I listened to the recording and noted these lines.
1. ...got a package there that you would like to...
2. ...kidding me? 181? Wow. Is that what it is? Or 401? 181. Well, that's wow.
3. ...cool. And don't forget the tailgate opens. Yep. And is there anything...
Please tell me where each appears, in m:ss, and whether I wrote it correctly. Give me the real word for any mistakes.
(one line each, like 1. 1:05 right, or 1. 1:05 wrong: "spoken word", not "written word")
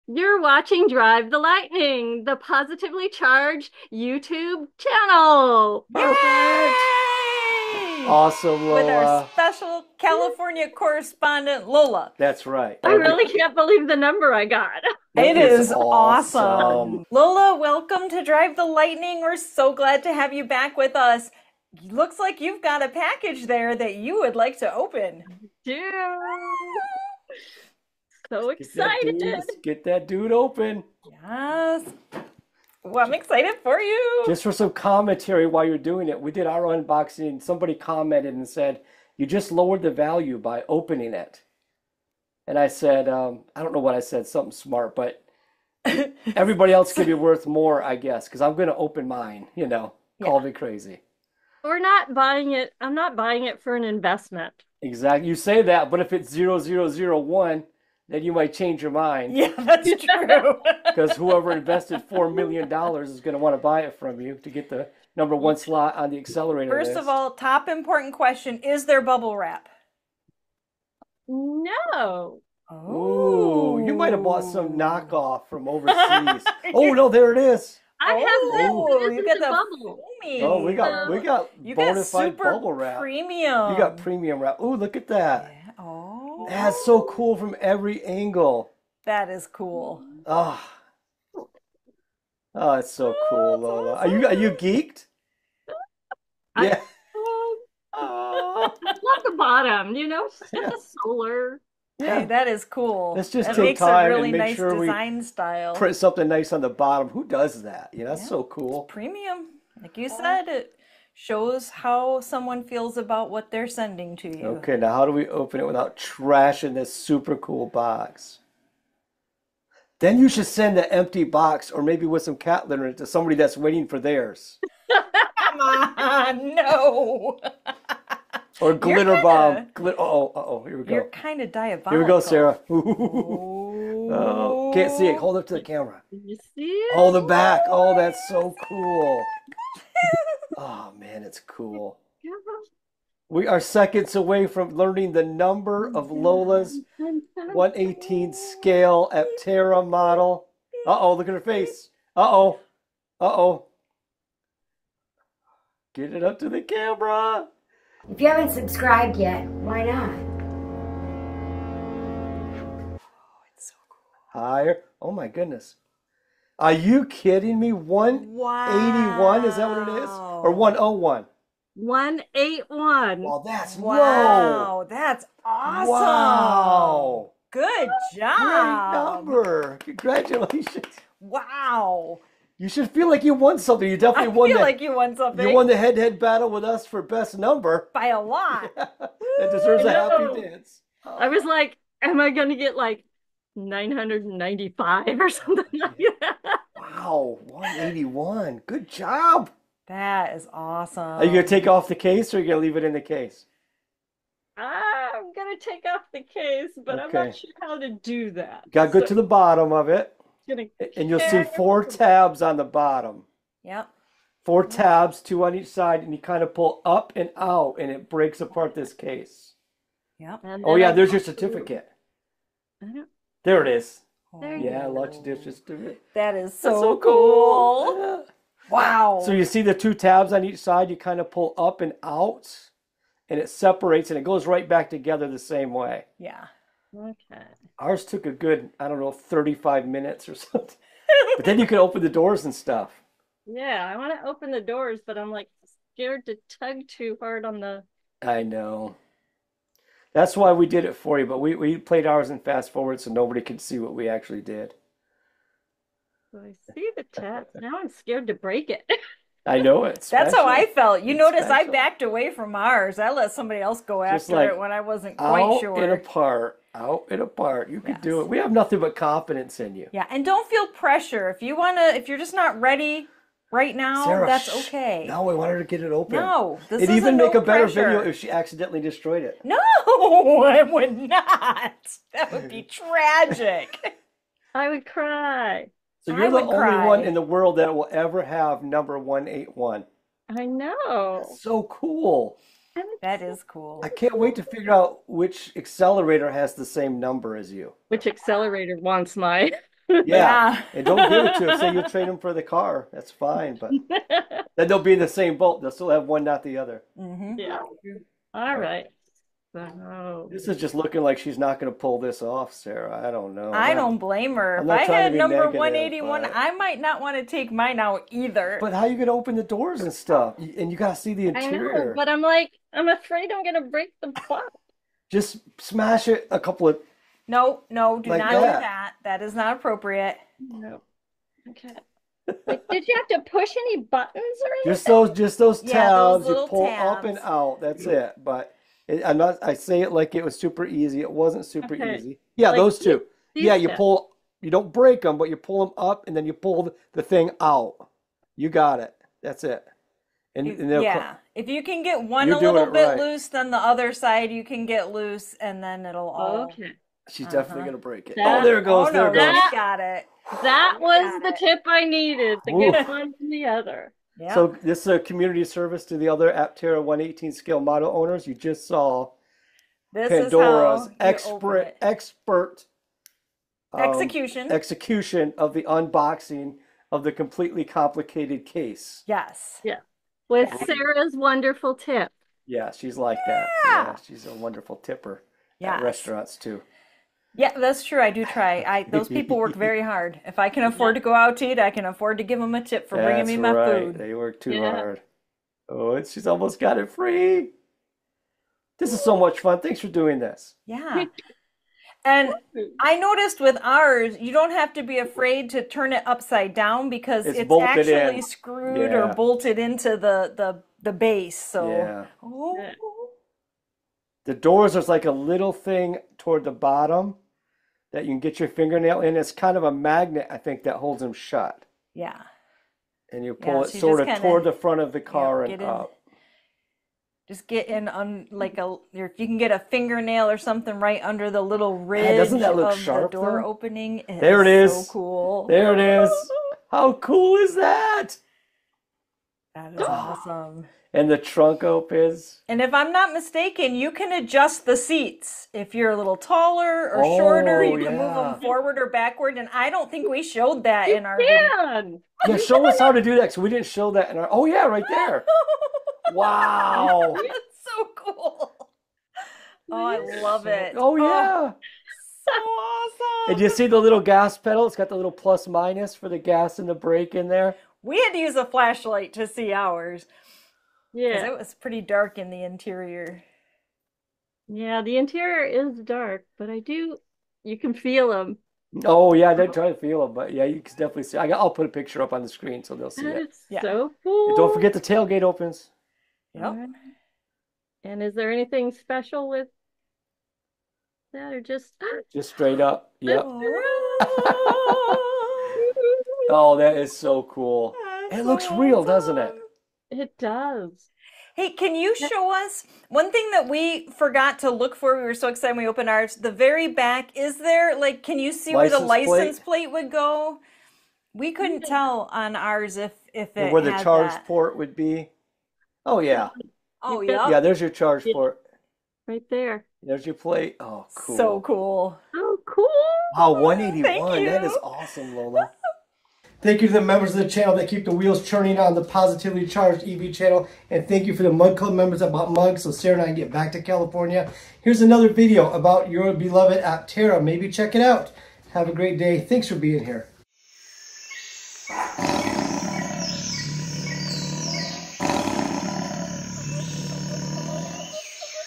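1. 0:22 right
2. 2:47 wrong: "101", not "401"
3. 8:04 right.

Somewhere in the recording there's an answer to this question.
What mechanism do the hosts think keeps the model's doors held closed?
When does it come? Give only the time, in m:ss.
6:59.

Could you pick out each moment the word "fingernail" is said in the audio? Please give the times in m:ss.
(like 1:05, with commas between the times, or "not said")
6:58, 7:09.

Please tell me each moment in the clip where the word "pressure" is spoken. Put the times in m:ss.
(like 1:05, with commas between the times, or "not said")
4:30, 4:37.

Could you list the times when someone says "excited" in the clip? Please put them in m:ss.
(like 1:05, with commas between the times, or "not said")
0:28, 0:33, 8:25.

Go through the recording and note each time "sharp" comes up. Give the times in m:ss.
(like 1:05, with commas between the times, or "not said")
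7:12.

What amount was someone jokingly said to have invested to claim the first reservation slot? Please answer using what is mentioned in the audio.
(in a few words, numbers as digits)
4 million dollars.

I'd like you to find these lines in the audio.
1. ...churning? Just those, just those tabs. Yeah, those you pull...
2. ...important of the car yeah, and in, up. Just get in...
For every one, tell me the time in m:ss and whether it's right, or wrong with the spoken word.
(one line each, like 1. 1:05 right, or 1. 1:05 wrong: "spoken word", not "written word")
1. 5:34 wrong: "anything", not "churning"
2. 7:04 wrong: "front", not "important".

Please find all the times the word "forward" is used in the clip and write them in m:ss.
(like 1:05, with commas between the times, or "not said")
4:12, 7:28.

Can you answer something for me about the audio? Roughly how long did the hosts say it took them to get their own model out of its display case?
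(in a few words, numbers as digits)
35 minutes.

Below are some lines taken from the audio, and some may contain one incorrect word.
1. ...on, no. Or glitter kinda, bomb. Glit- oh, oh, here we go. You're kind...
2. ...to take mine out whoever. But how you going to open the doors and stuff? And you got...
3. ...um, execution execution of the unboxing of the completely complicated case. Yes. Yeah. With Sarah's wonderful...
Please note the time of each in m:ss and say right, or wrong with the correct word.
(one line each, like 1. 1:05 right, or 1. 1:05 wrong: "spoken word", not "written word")
1. 2:05 right
2. 5:17 wrong: "either", not "whoever"
3. 6:13 right.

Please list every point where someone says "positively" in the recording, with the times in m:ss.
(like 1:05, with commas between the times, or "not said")
0:02, 8:48.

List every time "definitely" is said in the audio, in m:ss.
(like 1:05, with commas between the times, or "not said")
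3:03, 5:57, 8:00.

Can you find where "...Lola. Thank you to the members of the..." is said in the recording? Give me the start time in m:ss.
8:45.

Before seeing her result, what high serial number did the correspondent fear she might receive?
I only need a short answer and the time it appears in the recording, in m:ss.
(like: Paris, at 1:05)
995, at 3:13.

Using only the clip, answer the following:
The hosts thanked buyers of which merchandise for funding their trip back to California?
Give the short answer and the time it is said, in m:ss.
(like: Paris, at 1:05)
mugs, at 8:51.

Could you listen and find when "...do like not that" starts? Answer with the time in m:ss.
5:28.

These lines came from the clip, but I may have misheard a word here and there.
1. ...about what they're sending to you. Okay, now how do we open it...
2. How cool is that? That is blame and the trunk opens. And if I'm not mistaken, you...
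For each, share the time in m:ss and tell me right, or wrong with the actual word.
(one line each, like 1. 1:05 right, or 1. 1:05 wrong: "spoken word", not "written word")
1. 1:52 right
2. 7:16 wrong: "awesome", not "blame".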